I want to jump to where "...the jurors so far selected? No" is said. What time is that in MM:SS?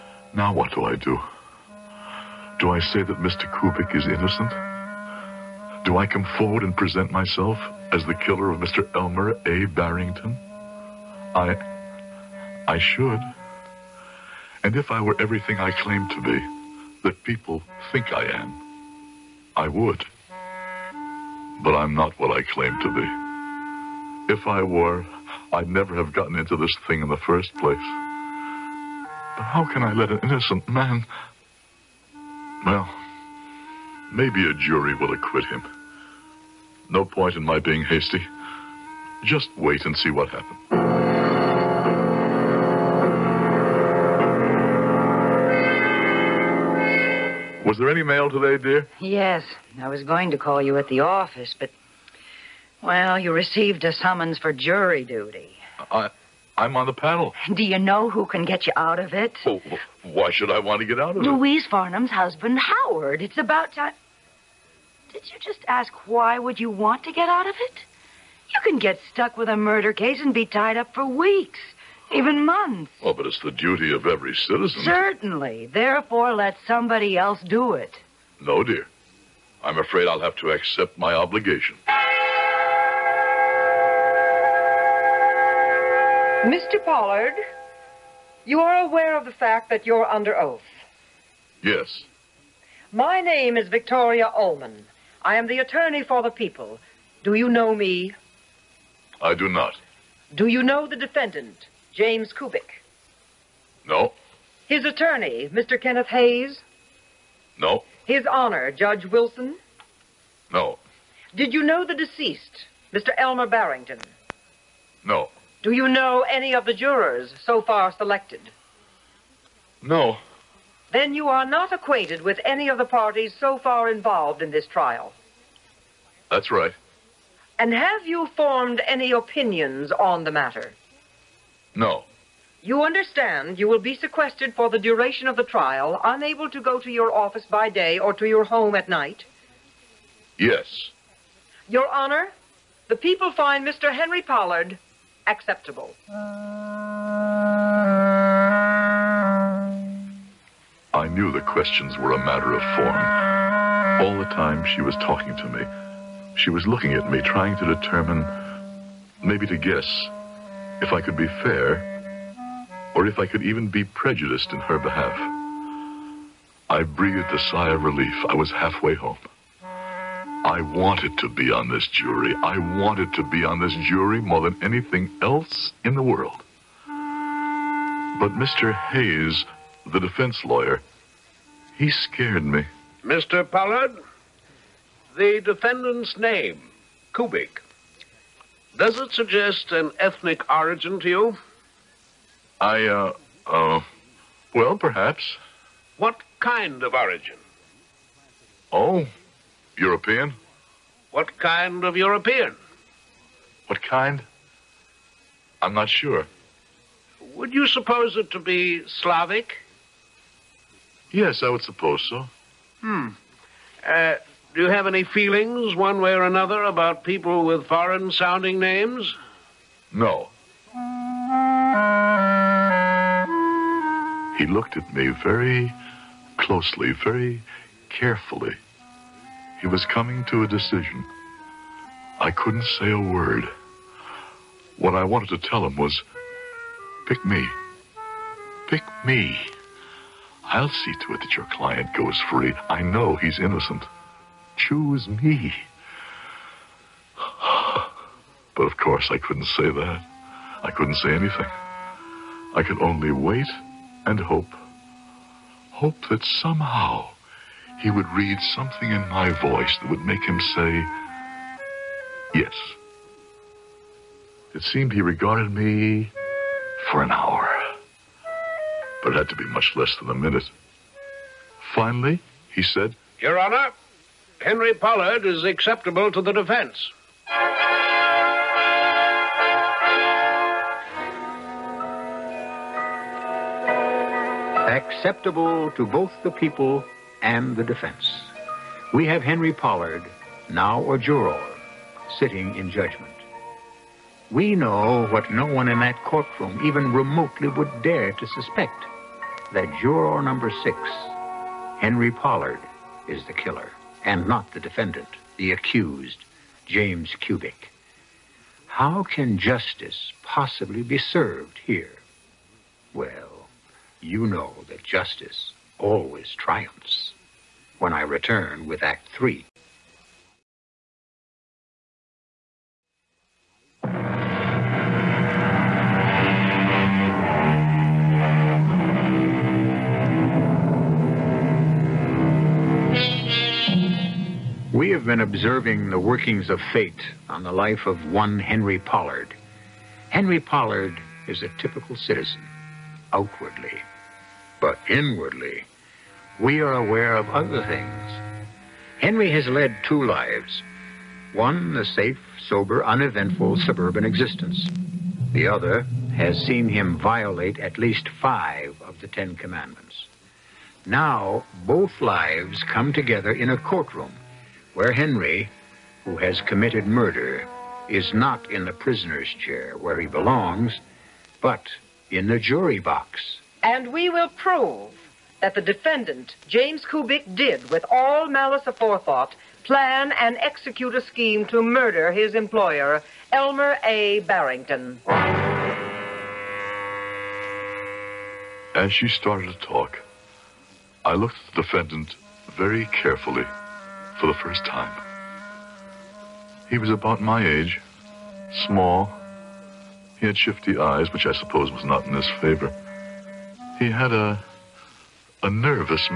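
01:56.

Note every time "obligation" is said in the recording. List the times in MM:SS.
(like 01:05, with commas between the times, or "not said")
01:21.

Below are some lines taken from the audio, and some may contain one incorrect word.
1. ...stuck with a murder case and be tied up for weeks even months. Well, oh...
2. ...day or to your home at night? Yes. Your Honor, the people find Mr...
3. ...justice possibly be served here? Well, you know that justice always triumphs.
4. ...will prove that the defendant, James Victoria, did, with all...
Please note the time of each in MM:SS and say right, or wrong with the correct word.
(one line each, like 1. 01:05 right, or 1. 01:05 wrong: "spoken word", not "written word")
1. 01:09 right
2. 02:17 right
3. 05:09 right
4. 06:14 wrong: "Kubik", not "Victoria".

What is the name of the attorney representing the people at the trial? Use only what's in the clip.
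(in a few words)
Victoria Ullman.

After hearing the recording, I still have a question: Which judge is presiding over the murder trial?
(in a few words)
Judge Wilson.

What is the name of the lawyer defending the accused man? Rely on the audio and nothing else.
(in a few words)
Kenneth Hayes.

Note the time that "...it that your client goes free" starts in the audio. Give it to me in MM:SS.
04:01.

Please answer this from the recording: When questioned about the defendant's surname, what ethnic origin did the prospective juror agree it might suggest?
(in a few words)
Slavic.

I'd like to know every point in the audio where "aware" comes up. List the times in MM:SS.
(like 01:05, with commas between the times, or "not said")
01:28, 05:46.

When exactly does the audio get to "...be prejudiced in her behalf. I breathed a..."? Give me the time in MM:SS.
02:43.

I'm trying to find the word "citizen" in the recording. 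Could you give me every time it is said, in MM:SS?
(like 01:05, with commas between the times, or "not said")
01:14, 05:41.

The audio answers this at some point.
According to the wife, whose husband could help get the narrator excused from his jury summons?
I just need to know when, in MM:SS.
01:01.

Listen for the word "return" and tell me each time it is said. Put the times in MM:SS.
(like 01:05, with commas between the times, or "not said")
05:18.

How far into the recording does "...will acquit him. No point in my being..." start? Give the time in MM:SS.
00:34.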